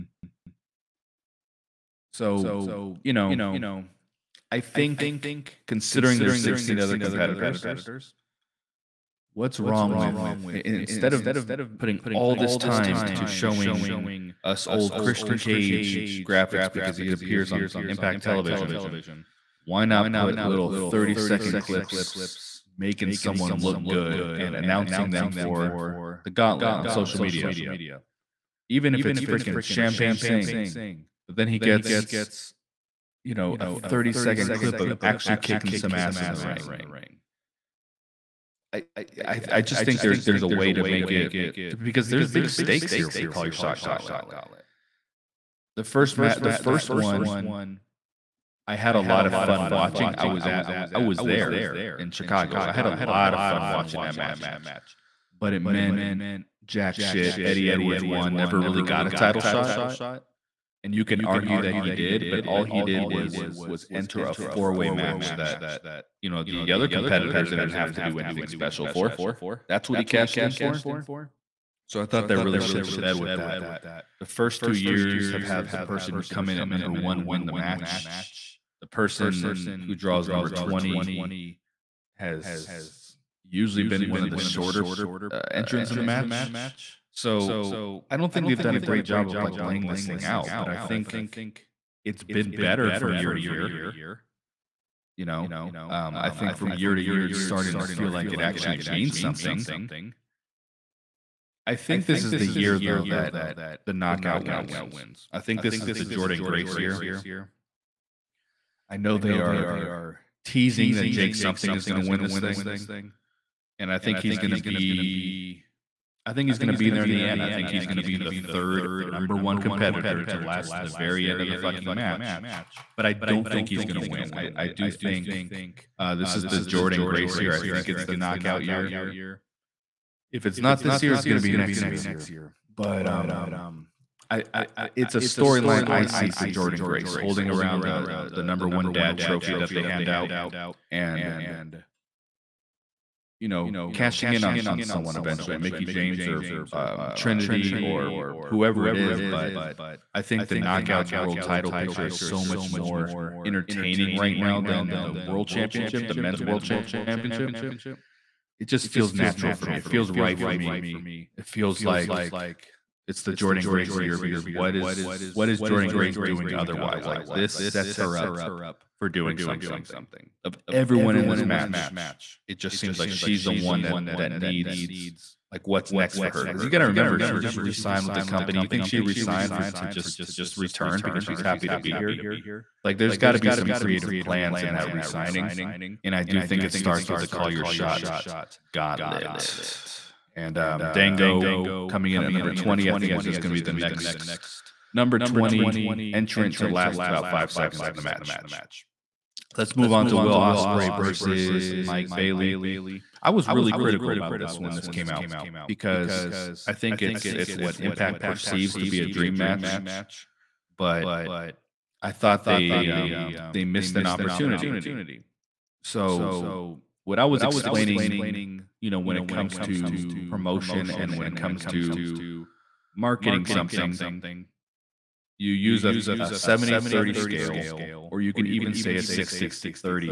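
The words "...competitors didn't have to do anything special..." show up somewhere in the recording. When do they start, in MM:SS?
01:06.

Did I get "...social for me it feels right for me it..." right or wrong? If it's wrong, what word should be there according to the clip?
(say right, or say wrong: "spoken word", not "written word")
wrong: "natural", not "social".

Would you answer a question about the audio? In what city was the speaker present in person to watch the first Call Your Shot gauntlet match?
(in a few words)
Chicago.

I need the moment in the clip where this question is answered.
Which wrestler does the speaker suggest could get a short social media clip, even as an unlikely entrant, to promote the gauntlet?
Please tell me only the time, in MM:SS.
00:29.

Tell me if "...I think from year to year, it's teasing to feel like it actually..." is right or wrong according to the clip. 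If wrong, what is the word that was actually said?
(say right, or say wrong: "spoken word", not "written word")
wrong: "starting", not "teasing".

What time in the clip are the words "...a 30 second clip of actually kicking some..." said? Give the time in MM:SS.
00:33.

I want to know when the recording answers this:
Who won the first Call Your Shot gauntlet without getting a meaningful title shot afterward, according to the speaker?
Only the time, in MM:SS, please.
00:57.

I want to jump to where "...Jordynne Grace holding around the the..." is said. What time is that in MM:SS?
02:16.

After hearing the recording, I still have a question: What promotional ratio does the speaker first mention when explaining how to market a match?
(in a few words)
70/30.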